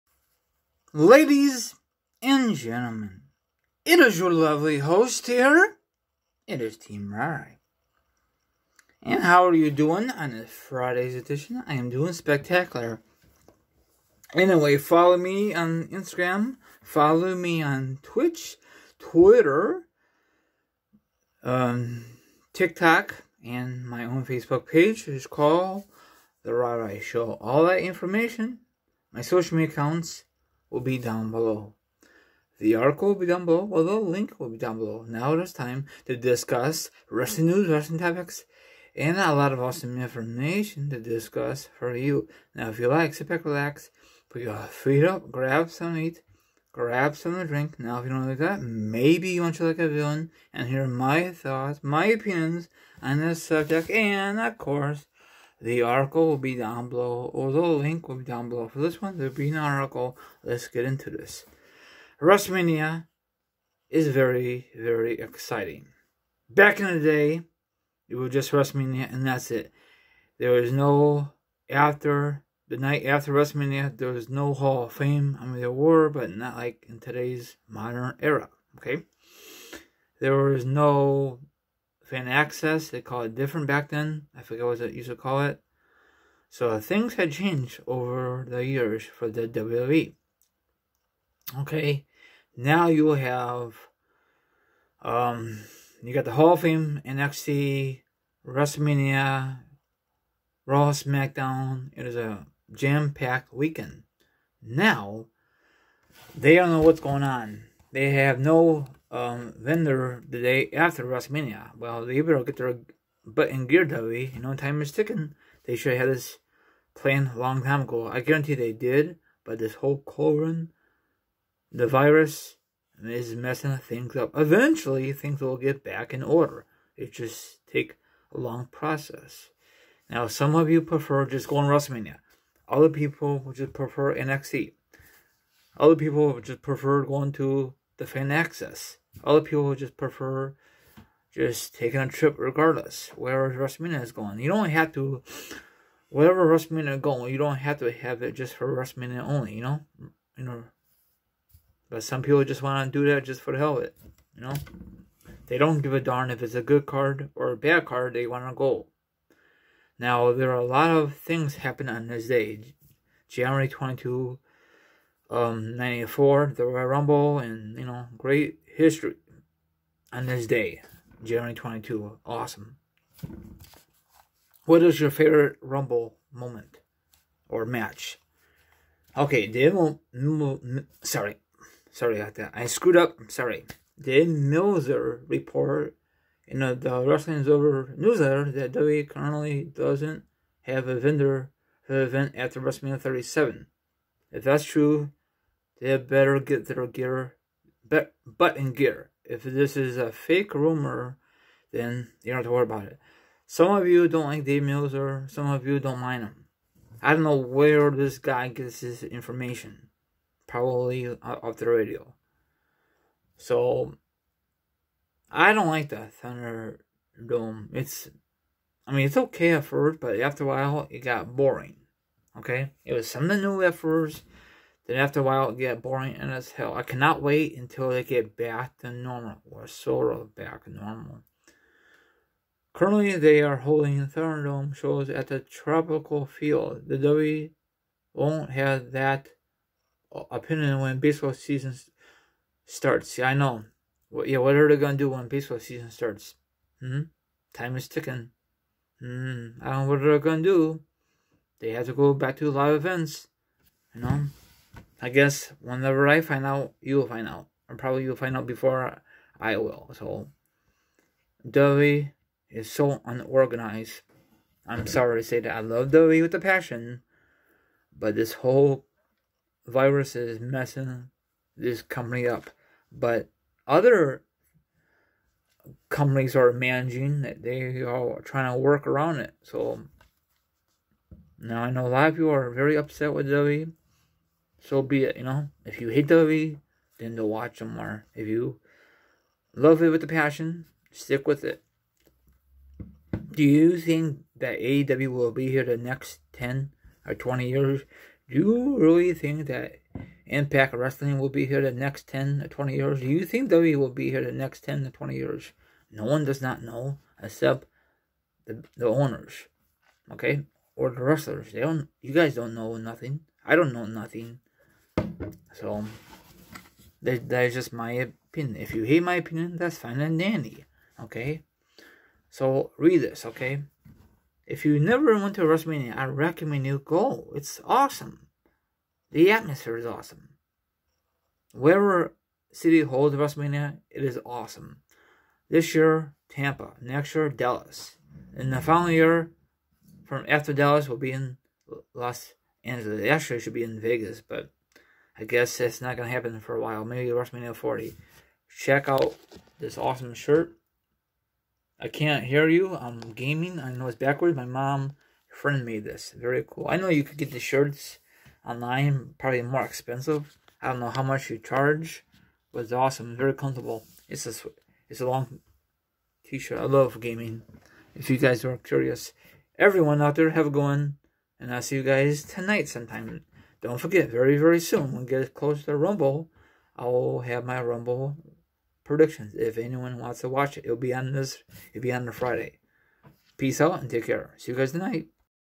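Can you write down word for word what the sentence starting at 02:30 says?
You know, but some people just want to do that just for the hell of it, you know?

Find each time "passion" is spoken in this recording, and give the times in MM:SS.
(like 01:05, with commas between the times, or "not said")
04:26, 04:50.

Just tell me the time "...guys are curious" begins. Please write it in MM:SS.
06:08.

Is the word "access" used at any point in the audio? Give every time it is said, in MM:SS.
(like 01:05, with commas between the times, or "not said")
01:22, 02:18.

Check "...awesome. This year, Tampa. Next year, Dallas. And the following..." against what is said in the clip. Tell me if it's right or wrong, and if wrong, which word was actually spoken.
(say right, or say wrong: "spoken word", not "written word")
right.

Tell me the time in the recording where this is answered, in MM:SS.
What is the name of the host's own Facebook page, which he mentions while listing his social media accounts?
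00:26.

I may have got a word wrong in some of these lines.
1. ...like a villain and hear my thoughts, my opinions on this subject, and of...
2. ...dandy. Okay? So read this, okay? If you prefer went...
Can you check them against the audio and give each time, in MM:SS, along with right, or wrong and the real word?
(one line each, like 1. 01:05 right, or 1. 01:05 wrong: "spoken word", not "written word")
1. 00:49 right
2. 05:20 wrong: "never", not "prefer".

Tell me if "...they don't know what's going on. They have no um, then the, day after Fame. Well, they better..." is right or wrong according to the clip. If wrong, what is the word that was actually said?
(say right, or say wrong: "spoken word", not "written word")
wrong: "WrestleMania", not "Fame".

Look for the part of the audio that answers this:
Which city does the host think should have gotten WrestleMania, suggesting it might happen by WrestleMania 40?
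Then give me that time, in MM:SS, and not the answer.
05:43.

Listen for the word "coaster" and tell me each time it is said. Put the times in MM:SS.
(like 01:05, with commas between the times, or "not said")
not said.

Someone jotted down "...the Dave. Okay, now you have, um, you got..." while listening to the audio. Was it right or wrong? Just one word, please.
wrong.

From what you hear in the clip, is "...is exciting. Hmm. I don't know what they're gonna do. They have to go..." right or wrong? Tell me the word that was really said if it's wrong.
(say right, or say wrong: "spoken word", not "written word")
wrong: "ticking", not "exciting".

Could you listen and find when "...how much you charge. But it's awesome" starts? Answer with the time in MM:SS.
06:00.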